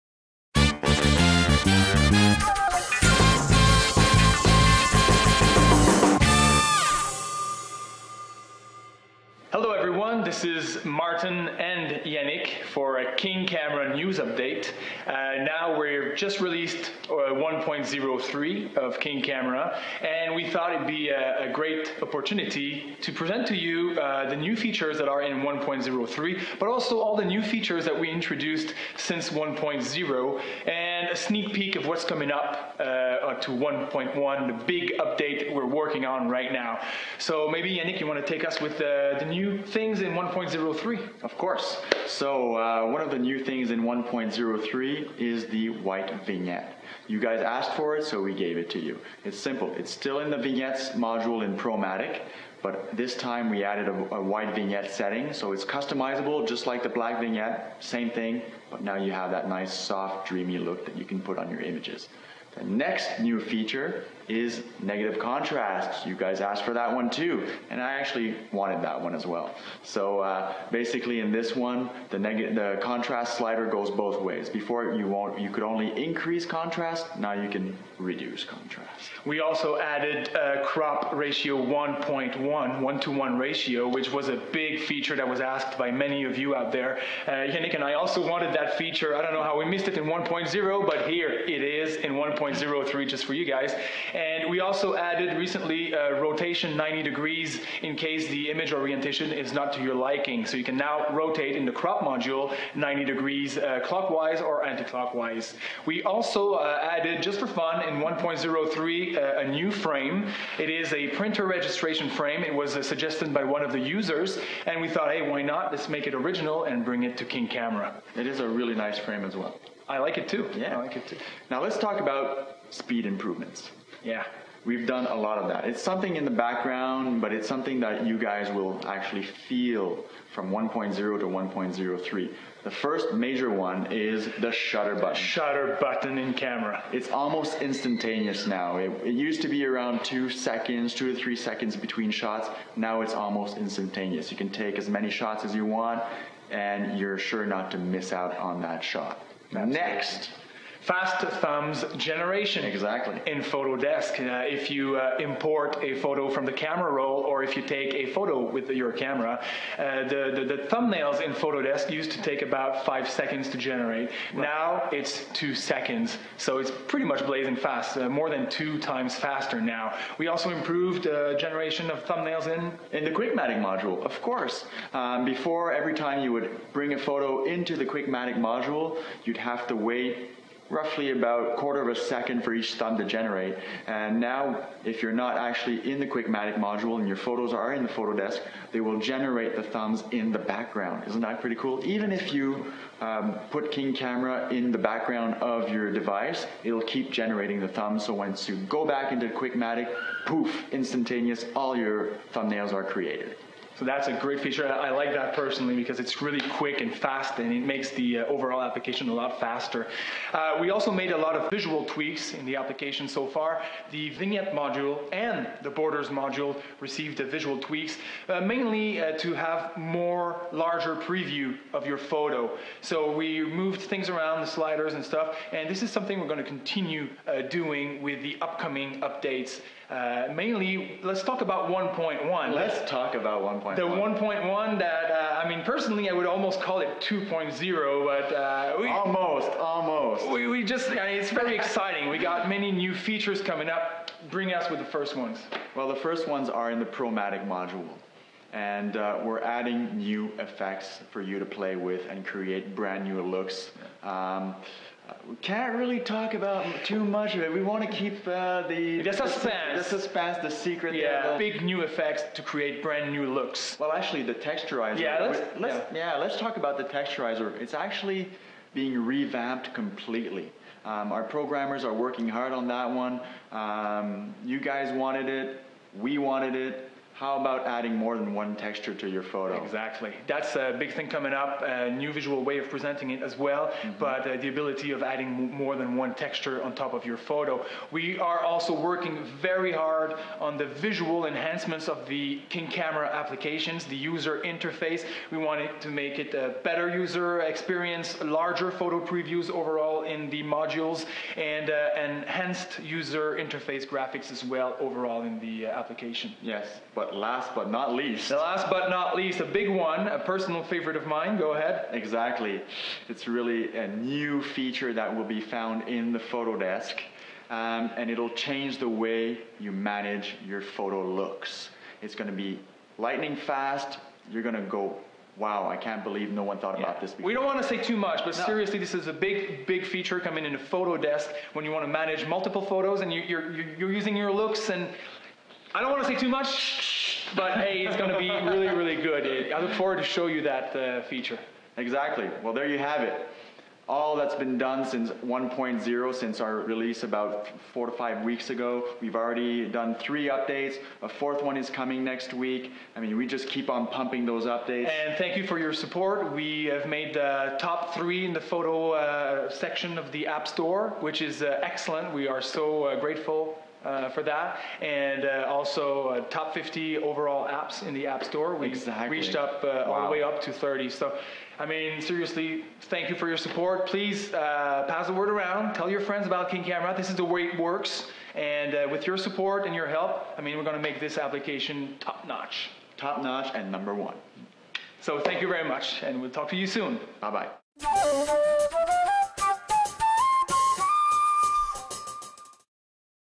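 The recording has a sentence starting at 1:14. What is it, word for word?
Before you won't, you could only increase contrast, now you can reduce contrast.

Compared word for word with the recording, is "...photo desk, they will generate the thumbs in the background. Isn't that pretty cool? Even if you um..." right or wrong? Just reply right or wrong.
right.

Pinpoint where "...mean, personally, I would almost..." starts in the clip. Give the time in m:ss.
3:55.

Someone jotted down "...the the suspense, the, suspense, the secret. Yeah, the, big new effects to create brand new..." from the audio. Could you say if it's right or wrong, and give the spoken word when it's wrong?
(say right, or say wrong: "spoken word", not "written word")
right.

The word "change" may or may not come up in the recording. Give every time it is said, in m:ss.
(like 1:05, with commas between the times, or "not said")
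5:18.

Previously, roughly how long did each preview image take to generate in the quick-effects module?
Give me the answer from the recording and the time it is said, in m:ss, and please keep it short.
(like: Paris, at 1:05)
Quarter of a second, at 3:01.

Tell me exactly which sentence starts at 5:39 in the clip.
I look forward to show you that uh, feature.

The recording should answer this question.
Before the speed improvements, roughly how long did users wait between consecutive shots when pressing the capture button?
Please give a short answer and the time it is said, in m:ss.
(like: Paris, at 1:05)
2 to 3 seconds, at 2:20.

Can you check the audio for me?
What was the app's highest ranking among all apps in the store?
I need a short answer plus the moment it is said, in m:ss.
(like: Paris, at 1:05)
30, at 6:10.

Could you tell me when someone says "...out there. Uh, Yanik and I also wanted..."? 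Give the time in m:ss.
1:26.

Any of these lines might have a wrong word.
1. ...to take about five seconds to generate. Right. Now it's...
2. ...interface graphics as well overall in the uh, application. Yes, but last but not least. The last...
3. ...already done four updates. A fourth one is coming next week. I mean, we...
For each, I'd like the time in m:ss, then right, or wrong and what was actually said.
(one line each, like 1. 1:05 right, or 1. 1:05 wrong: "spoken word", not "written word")
1. 2:42 right
2. 5:03 right
3. 5:49 wrong: "three", not "four".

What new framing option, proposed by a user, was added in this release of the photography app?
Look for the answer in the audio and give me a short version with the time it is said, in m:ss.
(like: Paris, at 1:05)
Printer registration frame, at 1:51.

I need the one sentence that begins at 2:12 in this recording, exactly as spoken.
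The first major one is the shutter button.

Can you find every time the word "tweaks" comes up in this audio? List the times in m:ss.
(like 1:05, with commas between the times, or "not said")
3:31, 3:37.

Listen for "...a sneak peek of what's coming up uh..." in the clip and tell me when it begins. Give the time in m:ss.
0:31.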